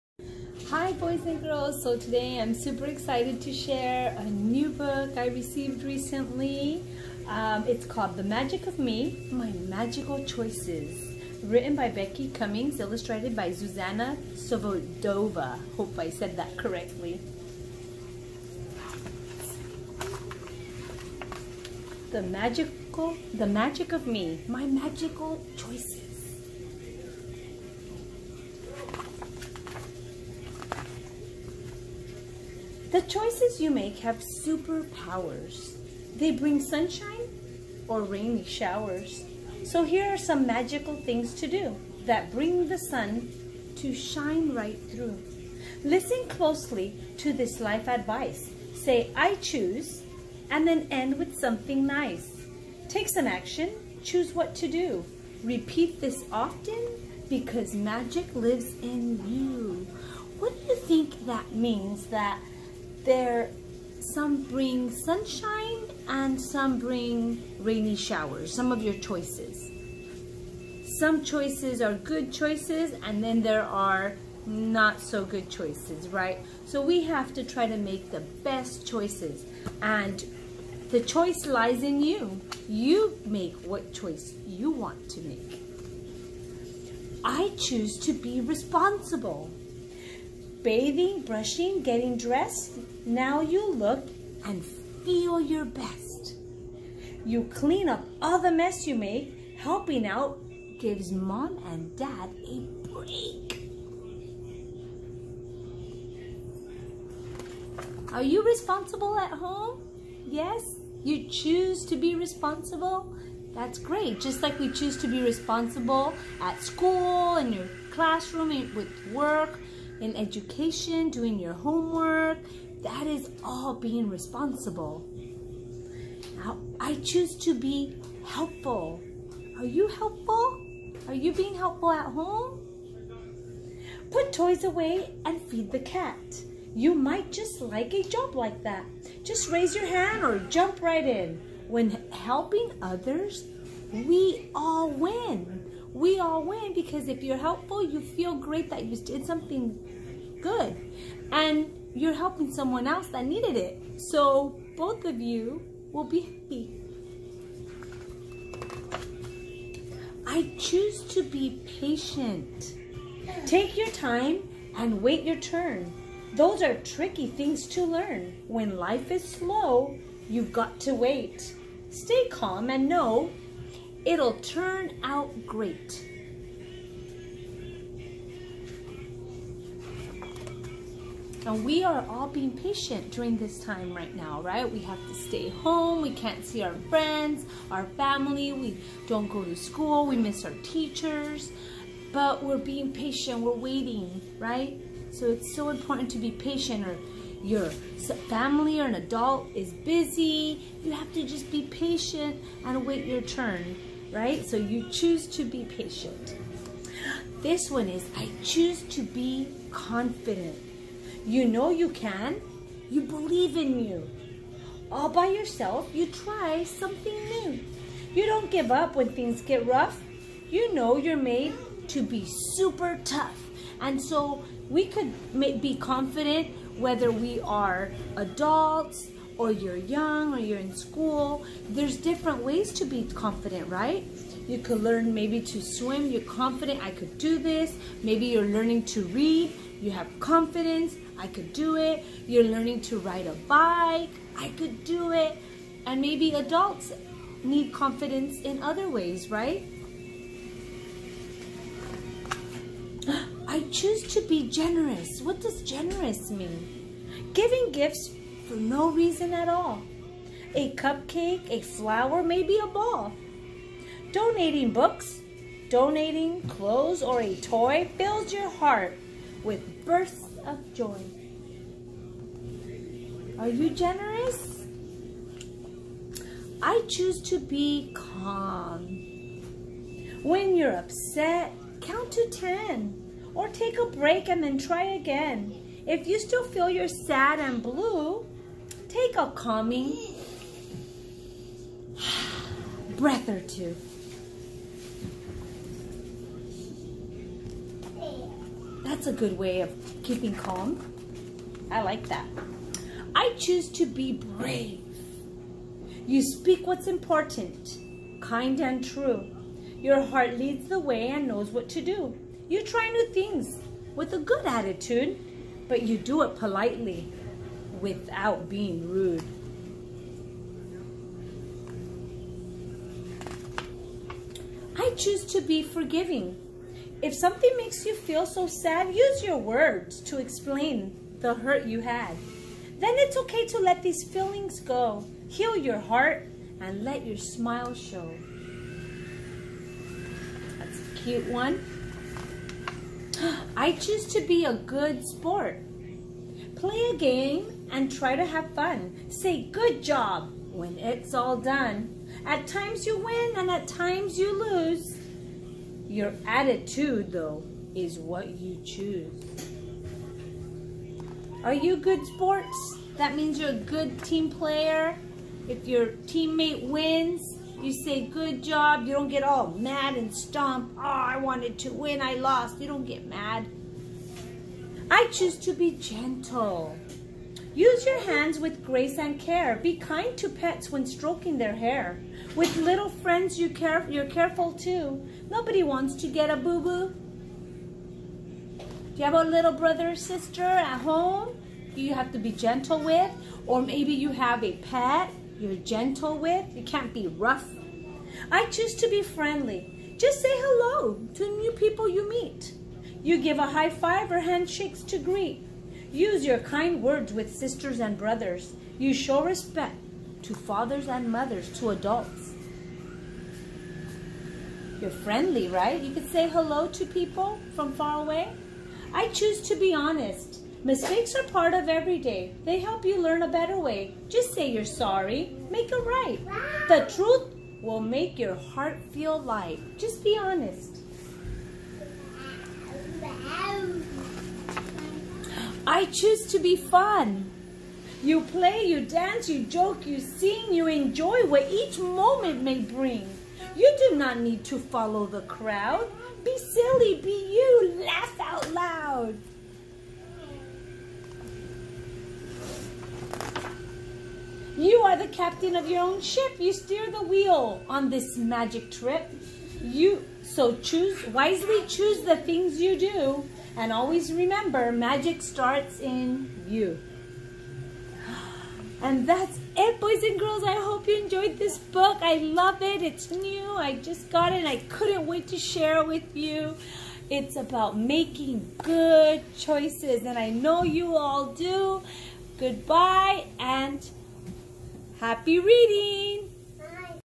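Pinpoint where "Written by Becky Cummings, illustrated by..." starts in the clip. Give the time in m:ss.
0:11.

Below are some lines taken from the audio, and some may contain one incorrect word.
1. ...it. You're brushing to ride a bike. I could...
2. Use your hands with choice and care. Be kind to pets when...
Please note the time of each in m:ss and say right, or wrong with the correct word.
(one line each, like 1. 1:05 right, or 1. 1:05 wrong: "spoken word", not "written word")
1. 4:01 wrong: "learning", not "brushing"
2. 6:17 wrong: "grace", not "choice".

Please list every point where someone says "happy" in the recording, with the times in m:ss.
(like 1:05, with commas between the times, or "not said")
2:36, 8:05.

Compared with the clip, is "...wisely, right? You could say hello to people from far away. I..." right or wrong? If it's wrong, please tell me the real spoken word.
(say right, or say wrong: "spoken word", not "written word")
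wrong: "friendly", not "wisely".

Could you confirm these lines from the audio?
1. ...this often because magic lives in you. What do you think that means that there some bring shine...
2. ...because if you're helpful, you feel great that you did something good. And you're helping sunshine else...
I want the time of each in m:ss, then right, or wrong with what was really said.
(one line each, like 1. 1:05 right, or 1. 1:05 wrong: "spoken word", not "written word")
1. 0:56 wrong: "sunshine", not "shine"
2. 2:26 wrong: "someone", not "sunshine".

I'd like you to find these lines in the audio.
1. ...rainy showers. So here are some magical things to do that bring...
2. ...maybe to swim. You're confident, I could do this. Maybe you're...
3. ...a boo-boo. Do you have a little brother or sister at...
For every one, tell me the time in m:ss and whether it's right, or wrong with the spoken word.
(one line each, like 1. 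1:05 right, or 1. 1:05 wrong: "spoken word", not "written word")
1. 0:38 right
2. 3:55 right
3. 6:26 right.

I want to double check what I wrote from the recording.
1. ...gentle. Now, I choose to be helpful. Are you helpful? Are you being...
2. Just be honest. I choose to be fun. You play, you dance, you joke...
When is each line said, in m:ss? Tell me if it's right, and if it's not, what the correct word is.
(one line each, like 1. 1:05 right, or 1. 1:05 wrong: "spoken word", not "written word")
1. 2:04 wrong: "responsible", not "gentle"
2. 7:09 right.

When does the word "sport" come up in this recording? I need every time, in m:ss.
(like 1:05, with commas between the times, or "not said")
5:45, 6:02.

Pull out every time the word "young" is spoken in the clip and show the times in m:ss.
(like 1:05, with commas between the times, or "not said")
3:49.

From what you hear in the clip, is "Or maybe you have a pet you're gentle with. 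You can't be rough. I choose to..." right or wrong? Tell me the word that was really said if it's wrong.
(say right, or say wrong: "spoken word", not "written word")
right.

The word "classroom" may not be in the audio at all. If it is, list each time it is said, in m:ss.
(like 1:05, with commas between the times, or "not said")
1:57.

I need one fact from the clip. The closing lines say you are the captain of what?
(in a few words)
your own ship.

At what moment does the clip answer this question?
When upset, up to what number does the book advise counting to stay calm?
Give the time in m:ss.
4:41.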